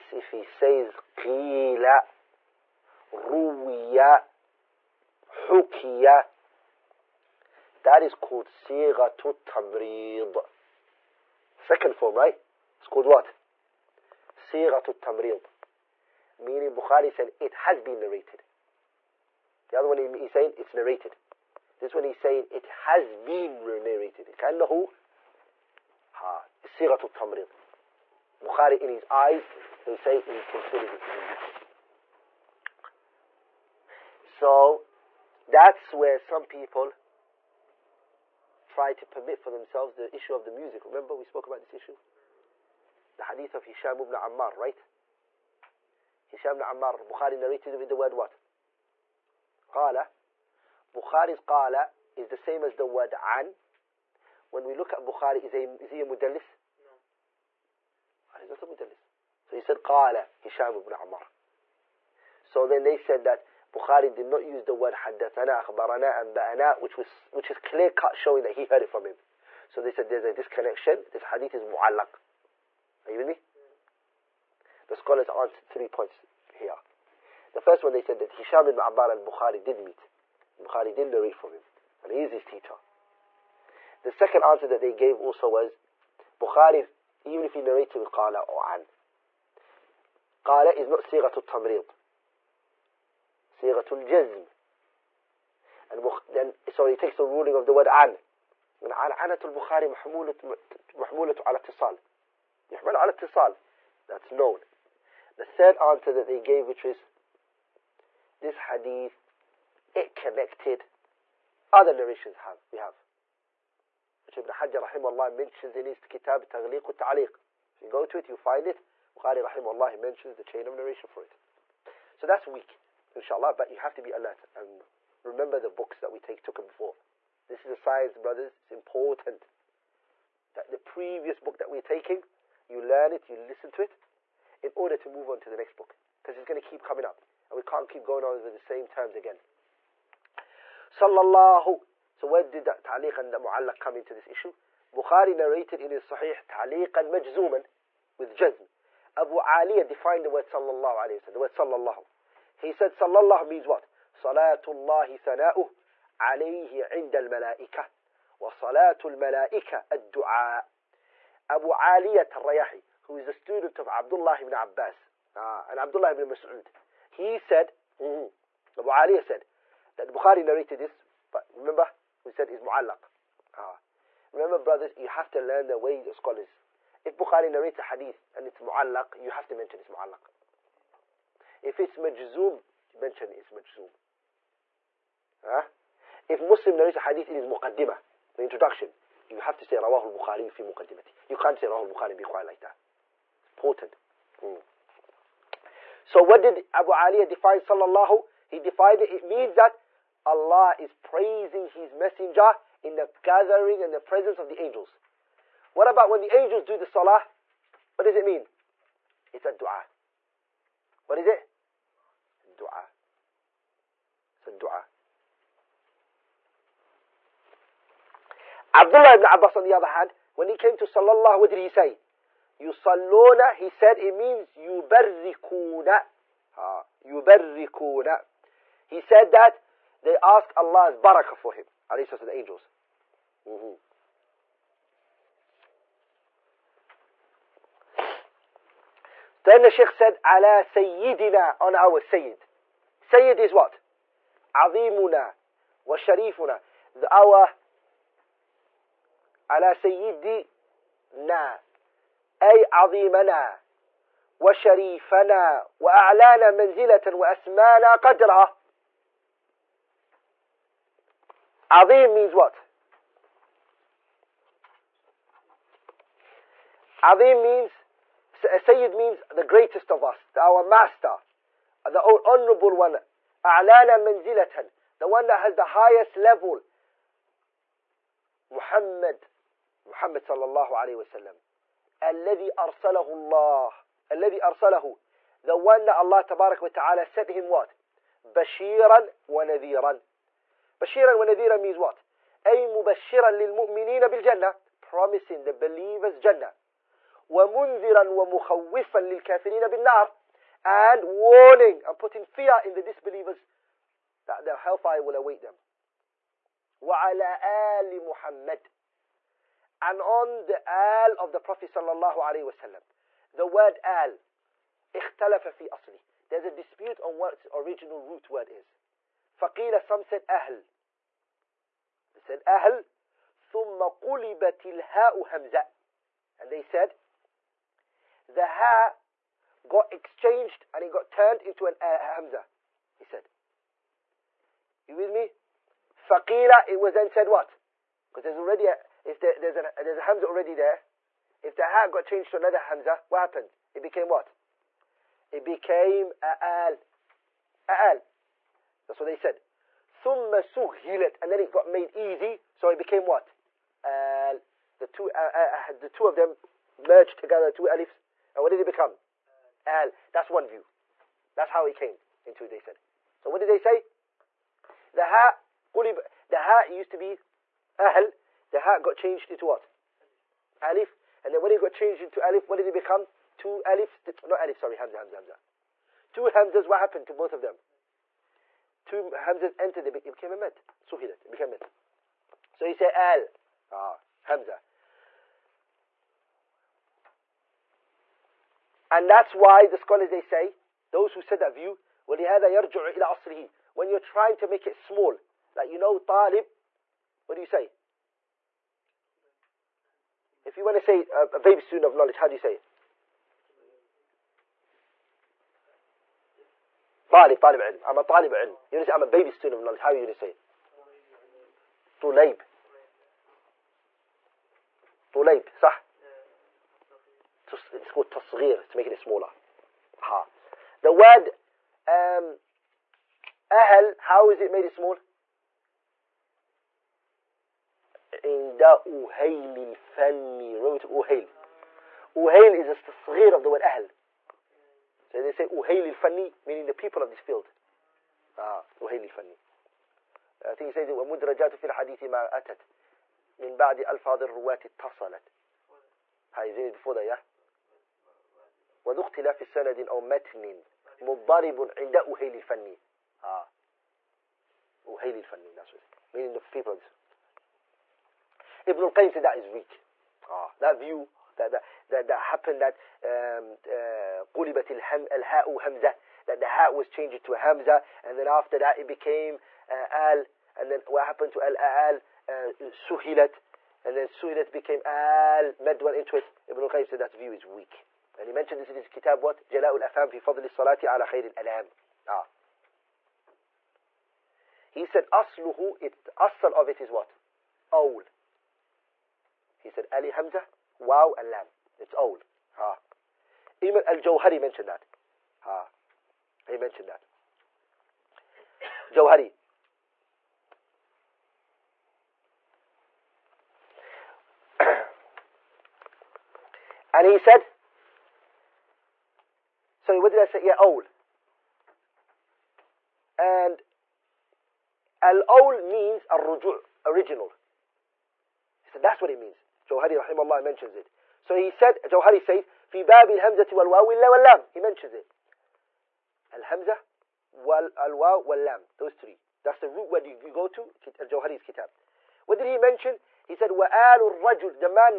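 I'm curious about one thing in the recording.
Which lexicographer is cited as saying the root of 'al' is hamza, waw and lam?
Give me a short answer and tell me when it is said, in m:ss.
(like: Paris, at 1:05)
al-Jawhari, at 8:13.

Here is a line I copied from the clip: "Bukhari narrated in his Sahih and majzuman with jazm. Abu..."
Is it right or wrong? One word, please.
right.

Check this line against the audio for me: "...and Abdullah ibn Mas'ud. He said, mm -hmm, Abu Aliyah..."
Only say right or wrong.
right.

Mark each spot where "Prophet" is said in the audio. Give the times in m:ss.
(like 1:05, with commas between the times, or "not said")
5:11.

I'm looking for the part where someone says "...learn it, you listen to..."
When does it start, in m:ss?
2:12.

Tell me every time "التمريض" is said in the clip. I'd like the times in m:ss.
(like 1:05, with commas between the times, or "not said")
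0:27.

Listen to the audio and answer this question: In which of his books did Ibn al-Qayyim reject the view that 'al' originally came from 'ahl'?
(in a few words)
Jala'ul Afham.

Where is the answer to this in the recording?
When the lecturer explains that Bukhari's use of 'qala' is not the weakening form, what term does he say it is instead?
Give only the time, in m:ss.
1:33.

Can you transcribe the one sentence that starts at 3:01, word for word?
If it's majzoom, you mention it's majzoom.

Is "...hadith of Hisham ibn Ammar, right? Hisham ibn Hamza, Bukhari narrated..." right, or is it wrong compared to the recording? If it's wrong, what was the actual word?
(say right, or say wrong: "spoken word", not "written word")
wrong: "Ammar", not "Hamza".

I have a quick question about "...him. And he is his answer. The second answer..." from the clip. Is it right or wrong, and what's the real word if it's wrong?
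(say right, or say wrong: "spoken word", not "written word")
wrong: "teacher", not "answer".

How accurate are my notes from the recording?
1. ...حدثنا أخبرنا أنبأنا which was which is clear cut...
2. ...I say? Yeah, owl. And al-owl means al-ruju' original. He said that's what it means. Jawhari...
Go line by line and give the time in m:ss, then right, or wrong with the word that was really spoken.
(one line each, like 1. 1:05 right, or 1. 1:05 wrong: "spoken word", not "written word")
1. 1:04 right
2. 8:30 right.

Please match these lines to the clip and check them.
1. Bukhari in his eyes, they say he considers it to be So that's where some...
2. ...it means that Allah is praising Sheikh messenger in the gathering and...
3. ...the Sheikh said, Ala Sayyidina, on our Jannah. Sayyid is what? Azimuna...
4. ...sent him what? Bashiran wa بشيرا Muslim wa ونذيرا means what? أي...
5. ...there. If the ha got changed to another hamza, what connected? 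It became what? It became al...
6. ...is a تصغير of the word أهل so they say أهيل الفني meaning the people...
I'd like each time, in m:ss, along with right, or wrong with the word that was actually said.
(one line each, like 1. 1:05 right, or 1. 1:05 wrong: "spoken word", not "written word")
1. 0:28 right
2. 3:19 wrong: "His", not "Sheikh"
3. 3:59 wrong: "Sayyid", not "Jannah"
4. 4:47 wrong: "Bashiran", not "Muslim"
5. 5:40 wrong: "happened", not "connected"
6. 7:12 right.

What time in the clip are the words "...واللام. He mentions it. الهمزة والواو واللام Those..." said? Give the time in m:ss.
8:43.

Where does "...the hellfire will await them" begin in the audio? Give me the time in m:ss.
5:04.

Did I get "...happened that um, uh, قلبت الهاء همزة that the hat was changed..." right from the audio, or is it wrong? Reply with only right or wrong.
right.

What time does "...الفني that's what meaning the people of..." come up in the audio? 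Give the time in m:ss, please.
7:35.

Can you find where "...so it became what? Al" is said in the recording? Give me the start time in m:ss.
5:52.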